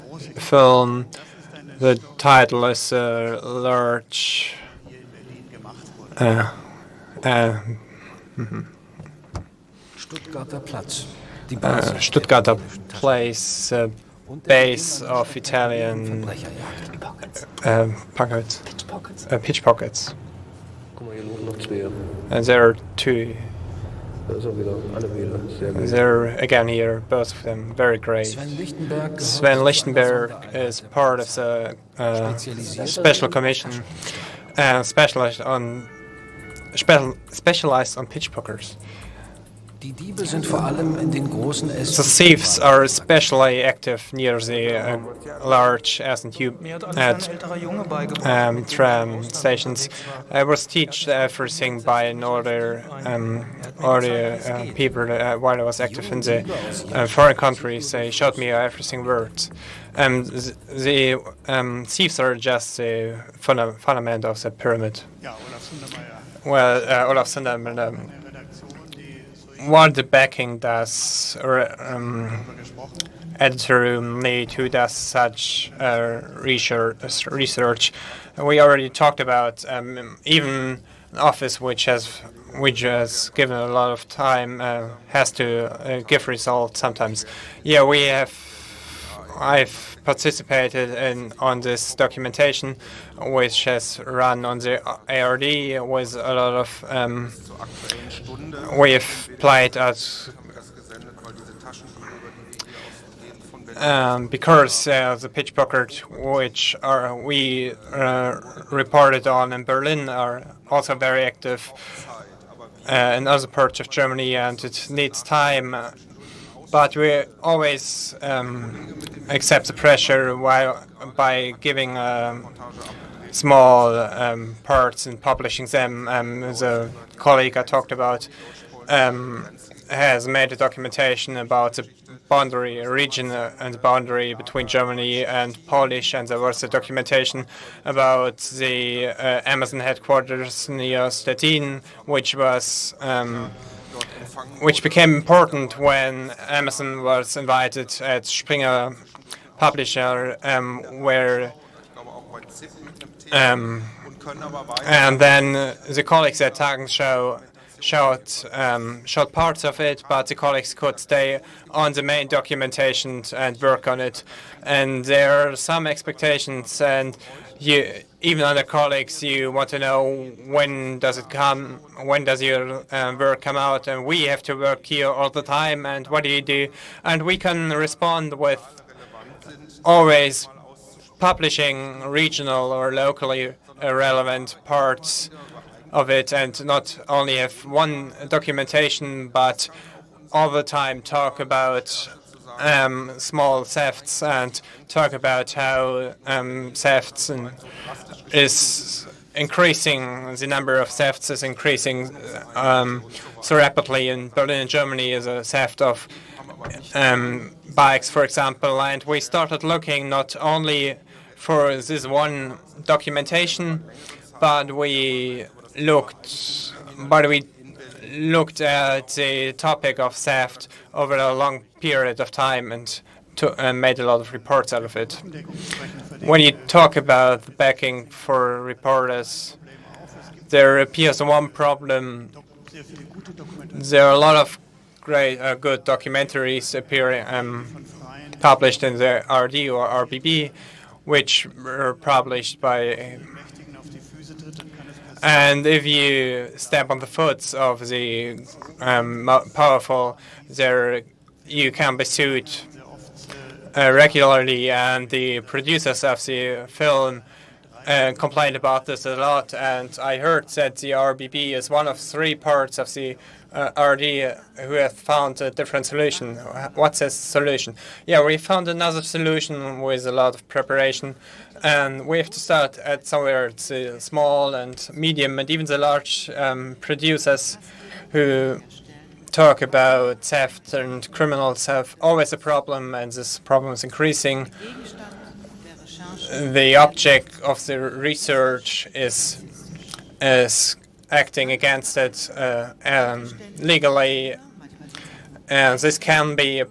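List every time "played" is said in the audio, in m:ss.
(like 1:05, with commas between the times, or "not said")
1:39.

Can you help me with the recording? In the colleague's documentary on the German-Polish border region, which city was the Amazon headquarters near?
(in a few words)
Stettin.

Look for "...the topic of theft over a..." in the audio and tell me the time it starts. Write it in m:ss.
3:39.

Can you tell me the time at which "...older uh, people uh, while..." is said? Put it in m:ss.
0:53.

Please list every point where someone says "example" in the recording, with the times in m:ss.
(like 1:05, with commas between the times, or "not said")
3:28.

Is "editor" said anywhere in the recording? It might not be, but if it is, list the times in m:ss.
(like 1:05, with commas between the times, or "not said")
1:13.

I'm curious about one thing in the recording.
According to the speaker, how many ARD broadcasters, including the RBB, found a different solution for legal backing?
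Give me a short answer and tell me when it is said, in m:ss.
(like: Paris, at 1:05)
3, at 4:21.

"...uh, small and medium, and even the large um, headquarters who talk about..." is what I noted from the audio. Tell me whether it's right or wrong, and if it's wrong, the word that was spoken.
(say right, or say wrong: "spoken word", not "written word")
wrong: "producers", not "headquarters".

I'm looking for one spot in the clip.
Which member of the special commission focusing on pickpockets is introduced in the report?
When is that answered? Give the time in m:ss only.
0:28.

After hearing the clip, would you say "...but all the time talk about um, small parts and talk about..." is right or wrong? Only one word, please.
wrong.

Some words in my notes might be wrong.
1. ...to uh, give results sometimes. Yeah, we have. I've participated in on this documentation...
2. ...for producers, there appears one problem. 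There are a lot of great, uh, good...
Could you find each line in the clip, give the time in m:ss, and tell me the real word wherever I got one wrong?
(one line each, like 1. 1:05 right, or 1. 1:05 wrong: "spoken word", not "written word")
1. 1:25 right
2. 3:48 wrong: "reporters", not "producers".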